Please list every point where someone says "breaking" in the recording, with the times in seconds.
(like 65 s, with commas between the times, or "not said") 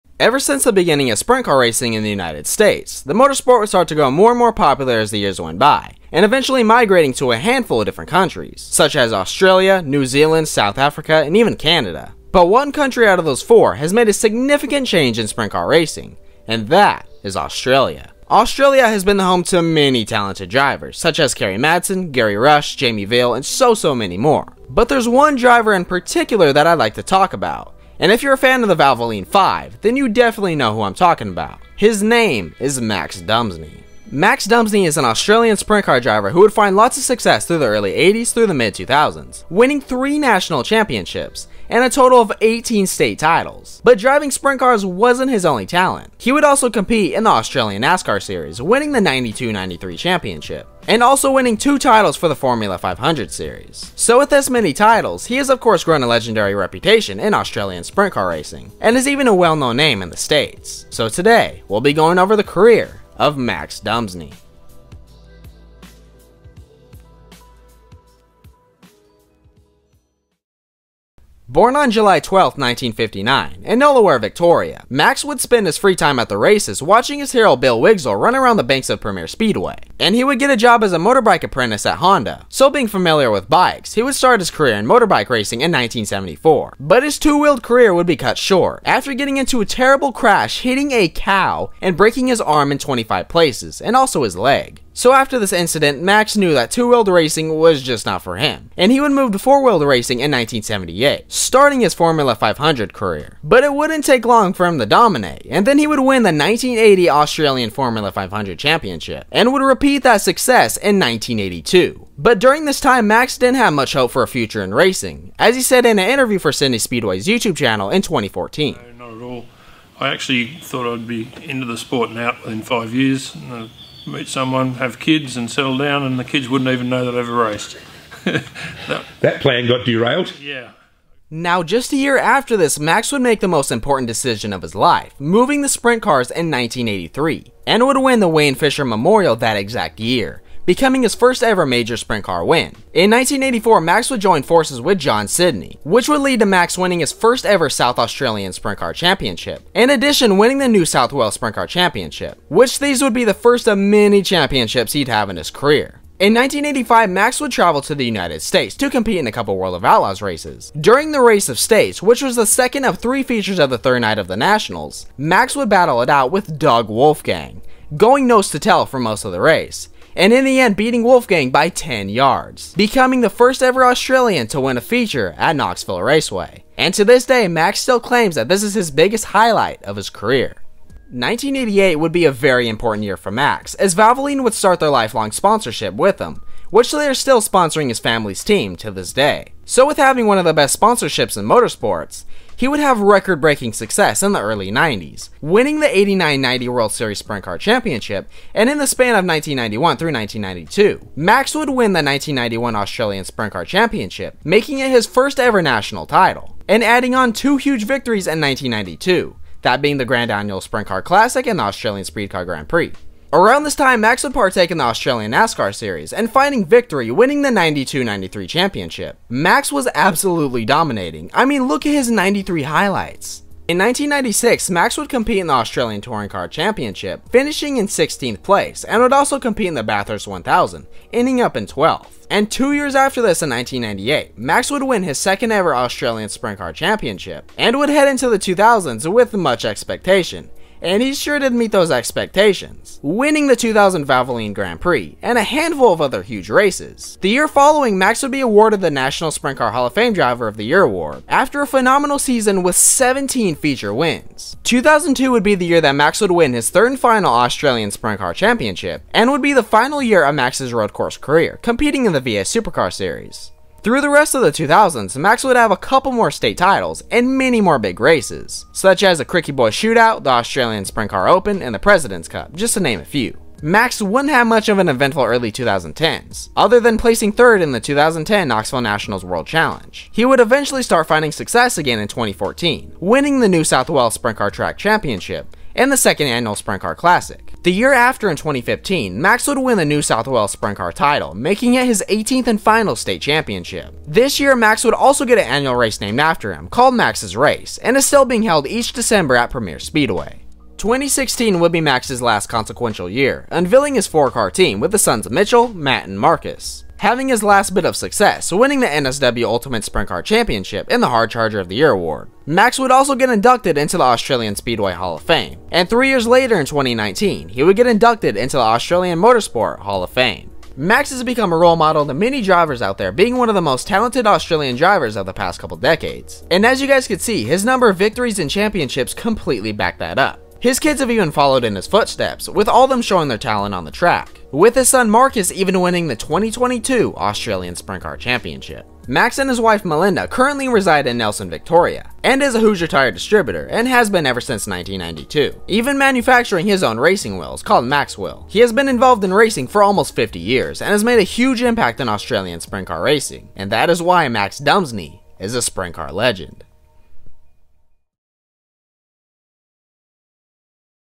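91 s, 193 s.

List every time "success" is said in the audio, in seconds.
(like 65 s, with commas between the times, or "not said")
37 s, 110 s, 193 s, 281 s, 307 s.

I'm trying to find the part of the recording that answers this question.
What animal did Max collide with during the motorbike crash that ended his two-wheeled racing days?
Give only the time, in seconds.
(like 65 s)
90 s.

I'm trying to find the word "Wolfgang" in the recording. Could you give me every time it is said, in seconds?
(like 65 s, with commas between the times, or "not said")
166 s, 171 s.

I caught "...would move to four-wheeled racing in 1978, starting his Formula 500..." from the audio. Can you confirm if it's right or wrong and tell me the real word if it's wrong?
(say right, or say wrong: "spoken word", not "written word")
right.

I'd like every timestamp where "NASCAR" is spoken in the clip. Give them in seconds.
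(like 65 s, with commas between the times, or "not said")
47 s, 215 s.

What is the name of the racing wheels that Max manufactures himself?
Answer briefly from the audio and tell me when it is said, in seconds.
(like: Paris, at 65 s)
Maxwell, at 347 s.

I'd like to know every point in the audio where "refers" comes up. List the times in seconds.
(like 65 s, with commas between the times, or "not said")
not said.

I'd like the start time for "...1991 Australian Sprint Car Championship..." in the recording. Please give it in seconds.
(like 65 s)
202 s.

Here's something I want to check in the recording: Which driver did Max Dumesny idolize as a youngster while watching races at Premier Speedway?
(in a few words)
Bill Wigzell.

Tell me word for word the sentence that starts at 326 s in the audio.
And as you guys can see, his number of victories and championships completely back that up.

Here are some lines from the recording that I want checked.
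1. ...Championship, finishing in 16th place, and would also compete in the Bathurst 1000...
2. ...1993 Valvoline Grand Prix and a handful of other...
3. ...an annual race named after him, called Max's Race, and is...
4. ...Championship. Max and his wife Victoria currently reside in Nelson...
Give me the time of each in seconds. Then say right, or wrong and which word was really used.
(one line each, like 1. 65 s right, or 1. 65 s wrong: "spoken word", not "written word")
1. 226 s right
2. 243 s wrong: "2000", not "1993"
3. 295 s right
4. 338 s wrong: "Melinda", not "Victoria".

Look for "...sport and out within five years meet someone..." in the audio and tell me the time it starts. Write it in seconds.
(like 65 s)
121 s.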